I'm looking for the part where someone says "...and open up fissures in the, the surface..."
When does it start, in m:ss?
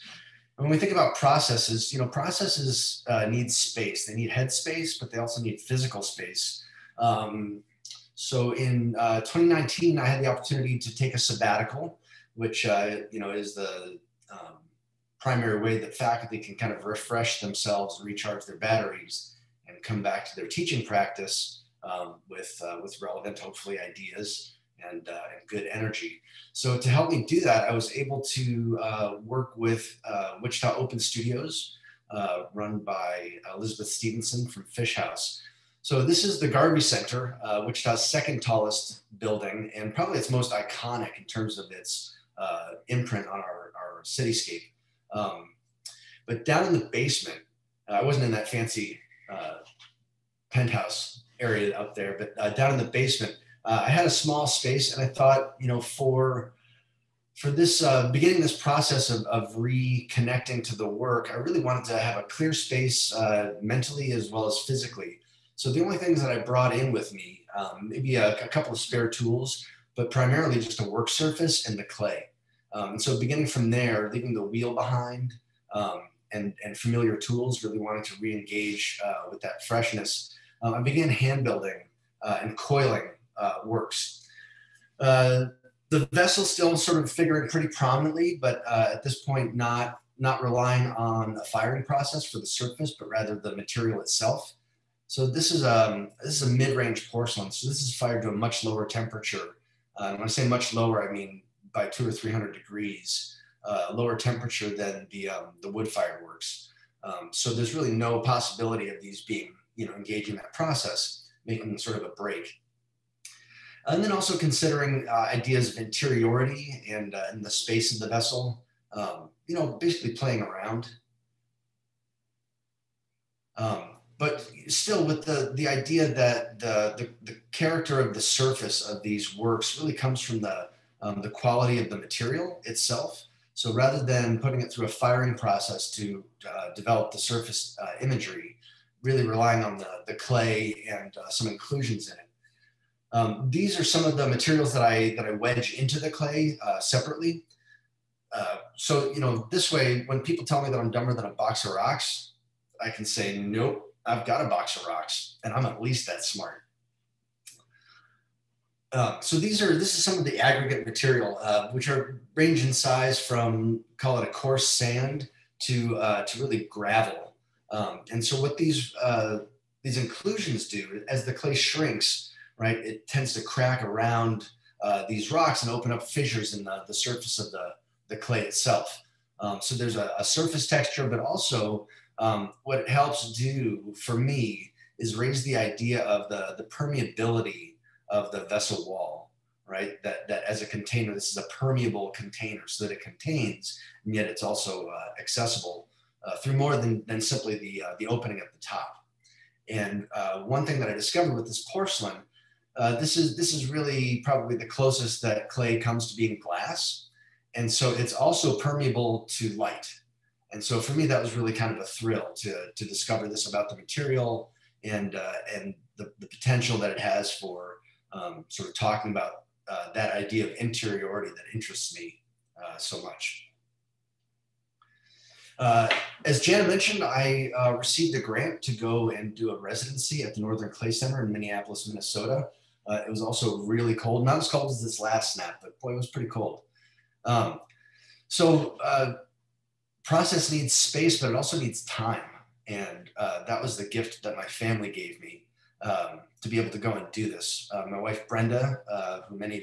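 2:55.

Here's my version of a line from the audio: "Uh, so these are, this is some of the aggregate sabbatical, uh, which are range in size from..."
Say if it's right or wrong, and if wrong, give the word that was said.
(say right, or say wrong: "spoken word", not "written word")
wrong: "material", not "sabbatical".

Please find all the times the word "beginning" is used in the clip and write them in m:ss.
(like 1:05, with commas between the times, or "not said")
0:58, 1:13.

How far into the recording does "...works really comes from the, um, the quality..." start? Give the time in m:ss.
2:09.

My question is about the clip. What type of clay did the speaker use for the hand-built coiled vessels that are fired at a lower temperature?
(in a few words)
mid-range porcelain.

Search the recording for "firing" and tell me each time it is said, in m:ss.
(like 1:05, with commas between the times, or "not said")
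1:31, 2:14.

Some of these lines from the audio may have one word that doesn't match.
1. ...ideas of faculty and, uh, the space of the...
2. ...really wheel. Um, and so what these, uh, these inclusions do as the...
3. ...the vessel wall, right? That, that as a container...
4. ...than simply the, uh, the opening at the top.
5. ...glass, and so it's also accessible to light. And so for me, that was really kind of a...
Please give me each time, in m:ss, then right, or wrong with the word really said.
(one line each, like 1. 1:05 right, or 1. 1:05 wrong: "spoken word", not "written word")
1. 1:55 wrong: "interiority", not "faculty"
2. 2:46 wrong: "gravel", not "wheel"
3. 3:08 right
4. 3:17 right
5. 3:26 wrong: "permeable", not "accessible".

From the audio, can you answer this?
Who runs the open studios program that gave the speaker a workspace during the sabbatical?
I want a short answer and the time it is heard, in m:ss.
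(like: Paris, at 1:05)
Elizabeth Stevenson, at 0:33.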